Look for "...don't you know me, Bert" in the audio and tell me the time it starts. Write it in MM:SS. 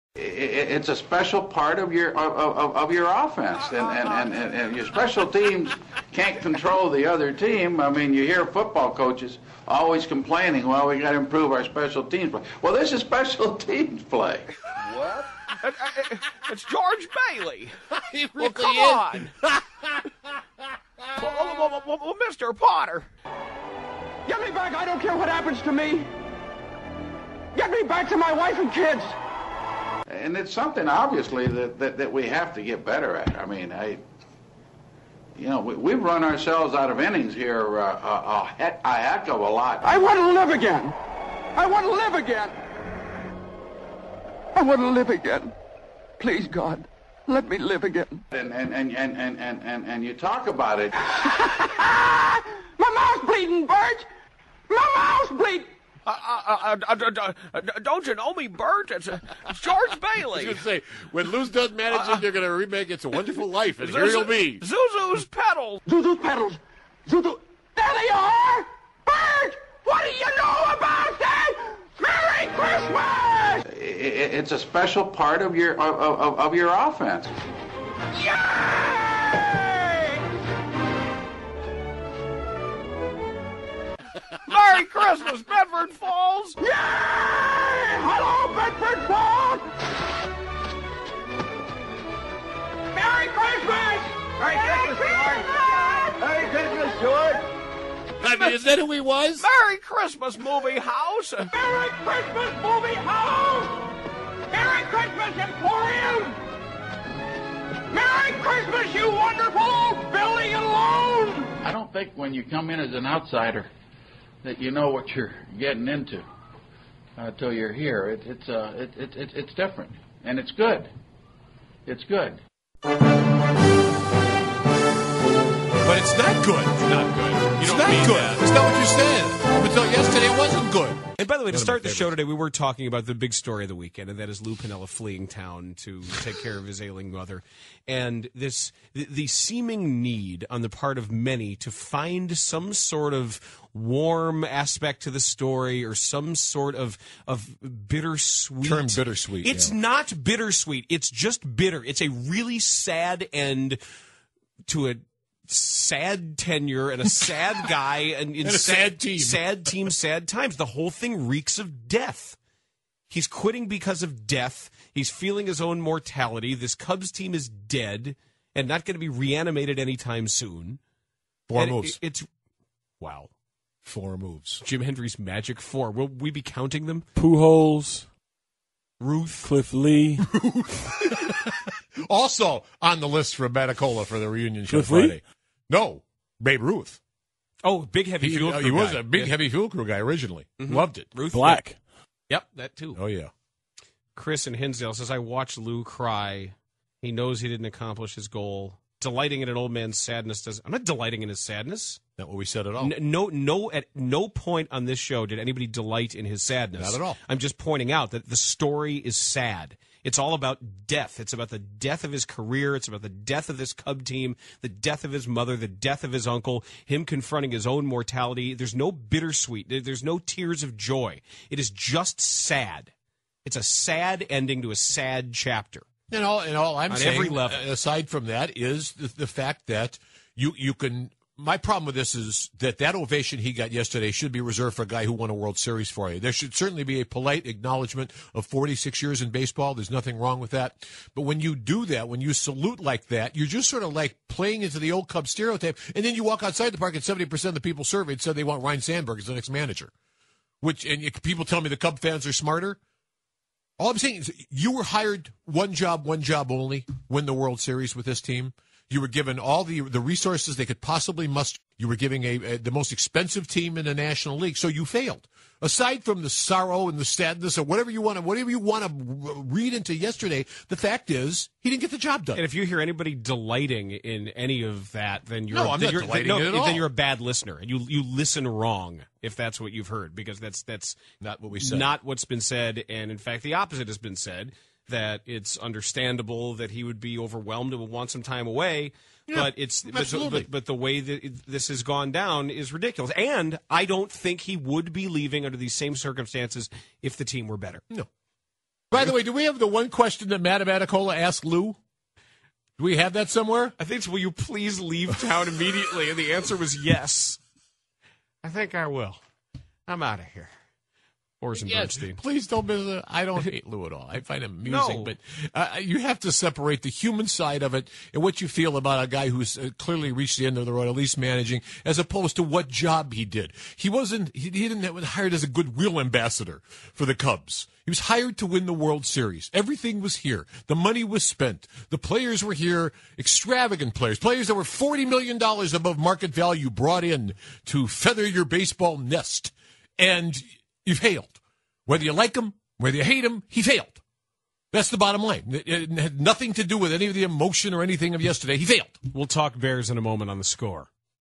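00:57.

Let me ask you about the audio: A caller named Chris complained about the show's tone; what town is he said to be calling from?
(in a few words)
Hinsdale.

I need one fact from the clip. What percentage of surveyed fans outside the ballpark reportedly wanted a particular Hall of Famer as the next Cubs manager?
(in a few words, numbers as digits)
70%.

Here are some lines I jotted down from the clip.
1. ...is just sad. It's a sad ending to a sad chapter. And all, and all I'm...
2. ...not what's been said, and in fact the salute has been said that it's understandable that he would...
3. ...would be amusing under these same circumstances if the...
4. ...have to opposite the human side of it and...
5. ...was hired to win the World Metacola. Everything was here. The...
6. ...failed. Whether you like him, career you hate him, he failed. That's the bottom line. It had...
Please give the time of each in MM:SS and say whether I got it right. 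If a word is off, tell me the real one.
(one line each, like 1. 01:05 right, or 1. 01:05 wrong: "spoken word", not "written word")
1. 03:41 right
2. 04:41 wrong: "opposite", not "salute"
3. 04:54 wrong: "leaving", not "amusing"
4. 05:15 wrong: "separate", not "opposite"
5. 05:27 wrong: "Series", not "Metacola"
6. 05:40 wrong: "whether", not "career".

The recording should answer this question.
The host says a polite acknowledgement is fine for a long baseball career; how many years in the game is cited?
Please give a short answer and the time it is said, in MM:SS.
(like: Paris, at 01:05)
46, at 03:58.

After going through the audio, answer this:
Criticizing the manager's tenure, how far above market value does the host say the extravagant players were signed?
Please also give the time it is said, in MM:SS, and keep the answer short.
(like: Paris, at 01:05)
$40 million, at 05:34.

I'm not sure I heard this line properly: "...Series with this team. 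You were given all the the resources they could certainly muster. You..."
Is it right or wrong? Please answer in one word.
wrong.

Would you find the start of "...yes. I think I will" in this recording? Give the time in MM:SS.
05:06.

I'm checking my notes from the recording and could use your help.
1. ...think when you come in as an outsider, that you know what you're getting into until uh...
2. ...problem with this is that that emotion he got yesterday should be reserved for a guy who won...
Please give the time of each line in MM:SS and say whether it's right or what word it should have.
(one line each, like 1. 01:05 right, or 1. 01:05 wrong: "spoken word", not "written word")
1. 01:51 right
2. 03:51 wrong: "ovation", not "emotion".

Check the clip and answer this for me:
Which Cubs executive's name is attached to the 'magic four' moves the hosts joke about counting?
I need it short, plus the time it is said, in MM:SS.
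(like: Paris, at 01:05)
Jim Hendry, at 02:54.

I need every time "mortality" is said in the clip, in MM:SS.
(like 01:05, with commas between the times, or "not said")
02:45, 03:37.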